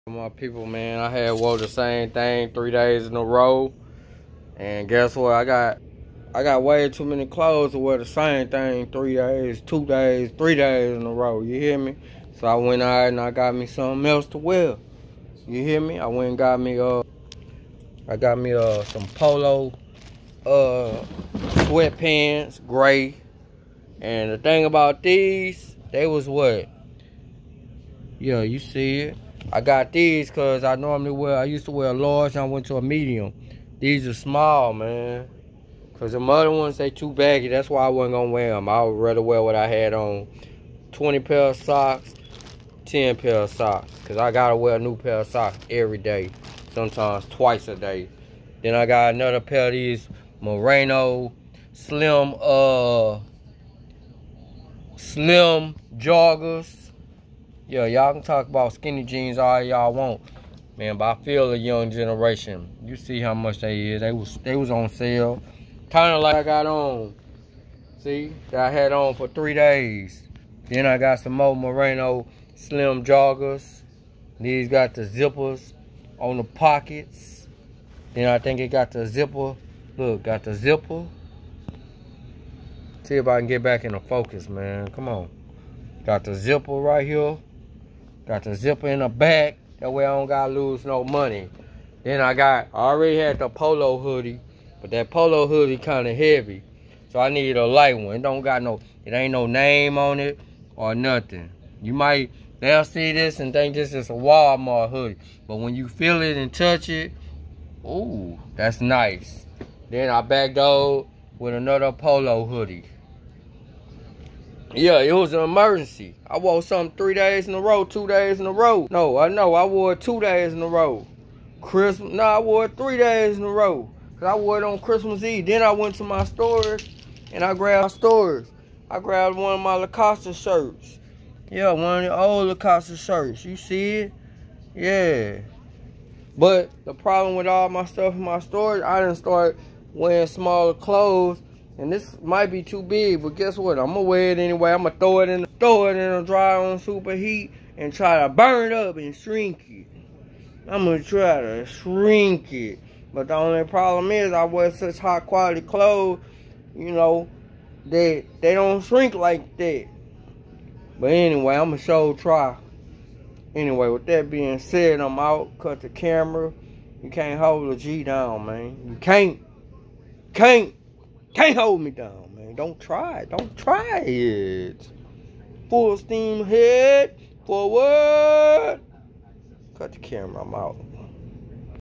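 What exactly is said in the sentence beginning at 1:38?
It don't got no, it ain't no name on it or nothing.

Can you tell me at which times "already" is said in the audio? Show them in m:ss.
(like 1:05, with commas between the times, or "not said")
1:32.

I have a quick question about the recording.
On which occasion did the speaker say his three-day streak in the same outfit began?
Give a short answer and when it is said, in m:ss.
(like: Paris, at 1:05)
Christmas Eve, at 2:04.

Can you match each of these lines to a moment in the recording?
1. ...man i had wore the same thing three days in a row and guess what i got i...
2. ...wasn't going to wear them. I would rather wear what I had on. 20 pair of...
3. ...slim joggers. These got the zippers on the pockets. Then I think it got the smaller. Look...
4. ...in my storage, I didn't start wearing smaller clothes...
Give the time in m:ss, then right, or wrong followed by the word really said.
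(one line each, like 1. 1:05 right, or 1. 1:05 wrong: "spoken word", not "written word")
1. 0:00 right
2. 0:37 right
3. 1:12 wrong: "zipper", not "smaller"
4. 2:18 right.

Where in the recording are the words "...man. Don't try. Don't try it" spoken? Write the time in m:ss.
2:52.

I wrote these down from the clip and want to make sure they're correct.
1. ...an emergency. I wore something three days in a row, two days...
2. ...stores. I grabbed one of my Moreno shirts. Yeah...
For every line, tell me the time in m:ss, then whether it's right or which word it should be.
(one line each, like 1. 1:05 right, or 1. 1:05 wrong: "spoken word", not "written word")
1. 1:55 right
2. 2:07 wrong: "Lacoste", not "Moreno".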